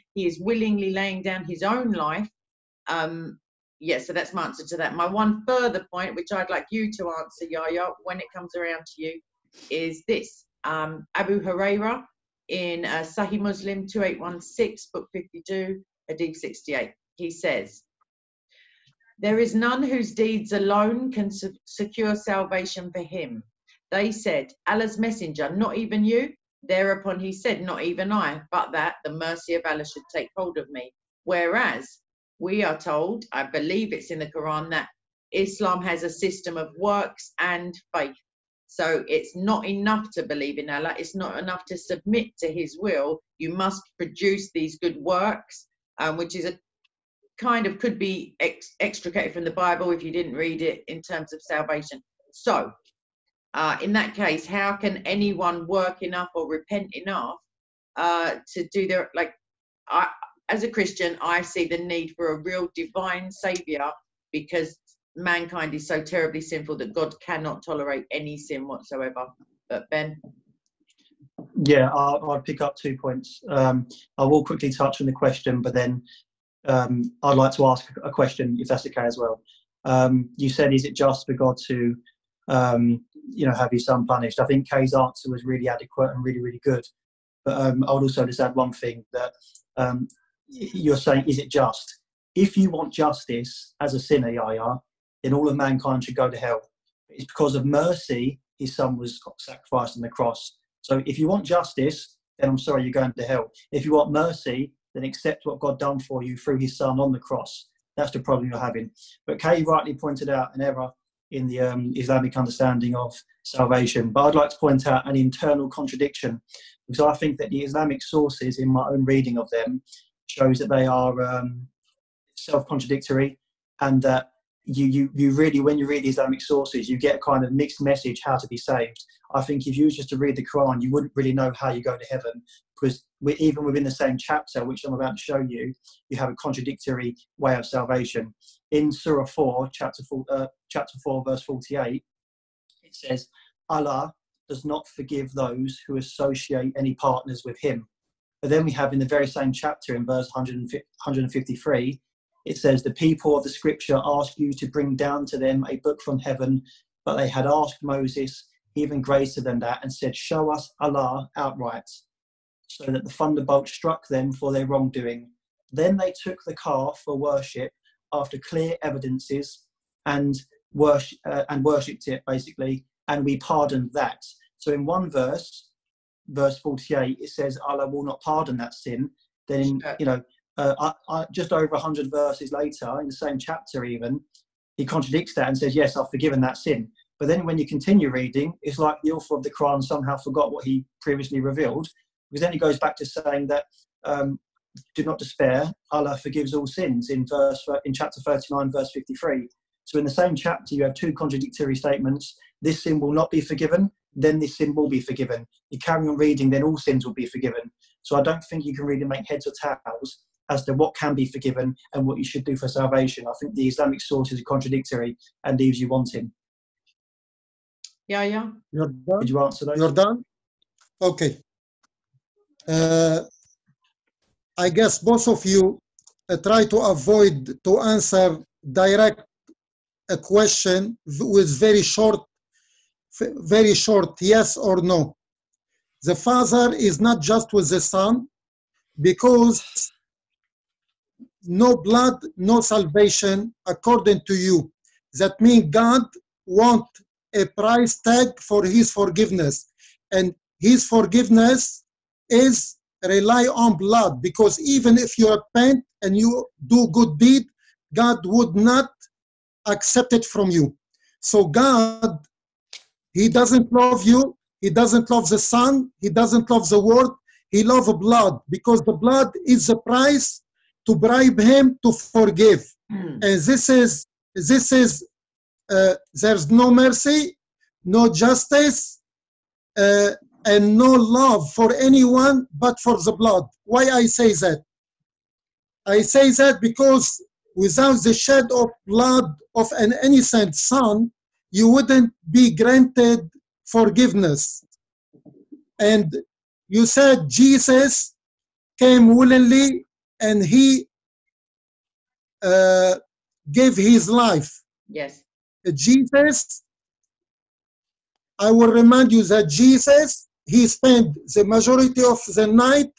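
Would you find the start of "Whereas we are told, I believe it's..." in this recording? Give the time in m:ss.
0:31.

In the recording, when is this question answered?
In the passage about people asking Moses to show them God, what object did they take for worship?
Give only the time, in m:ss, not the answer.
2:46.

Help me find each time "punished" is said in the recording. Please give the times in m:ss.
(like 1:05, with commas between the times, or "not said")
1:24.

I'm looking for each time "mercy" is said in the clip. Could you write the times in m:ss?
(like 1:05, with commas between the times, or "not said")
0:29, 1:37, 1:44, 4:36.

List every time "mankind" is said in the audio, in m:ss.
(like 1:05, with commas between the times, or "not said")
1:05, 1:35.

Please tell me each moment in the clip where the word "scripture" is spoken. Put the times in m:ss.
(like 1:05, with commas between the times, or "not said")
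2:33.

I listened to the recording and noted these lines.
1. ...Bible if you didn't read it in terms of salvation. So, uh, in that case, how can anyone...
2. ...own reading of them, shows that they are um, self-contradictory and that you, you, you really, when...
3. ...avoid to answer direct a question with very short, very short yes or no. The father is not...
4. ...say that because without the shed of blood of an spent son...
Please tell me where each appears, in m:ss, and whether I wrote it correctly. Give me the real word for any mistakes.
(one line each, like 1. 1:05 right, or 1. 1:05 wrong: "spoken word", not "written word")
1. 0:49 right
2. 1:58 right
3. 3:46 right
4. 4:46 wrong: "innocent", not "spent".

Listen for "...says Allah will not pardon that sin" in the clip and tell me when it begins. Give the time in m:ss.
2:57.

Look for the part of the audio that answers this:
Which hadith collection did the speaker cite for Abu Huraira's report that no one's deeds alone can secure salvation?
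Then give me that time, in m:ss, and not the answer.
0:13.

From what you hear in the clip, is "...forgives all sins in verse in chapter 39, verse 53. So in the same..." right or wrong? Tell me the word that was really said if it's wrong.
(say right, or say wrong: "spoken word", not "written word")
right.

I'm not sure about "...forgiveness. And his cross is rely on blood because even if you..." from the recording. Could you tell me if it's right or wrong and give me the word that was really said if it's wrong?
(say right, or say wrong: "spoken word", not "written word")
wrong: "forgiveness", not "cross".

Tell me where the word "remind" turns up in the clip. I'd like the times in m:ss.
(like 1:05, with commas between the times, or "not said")
5:08.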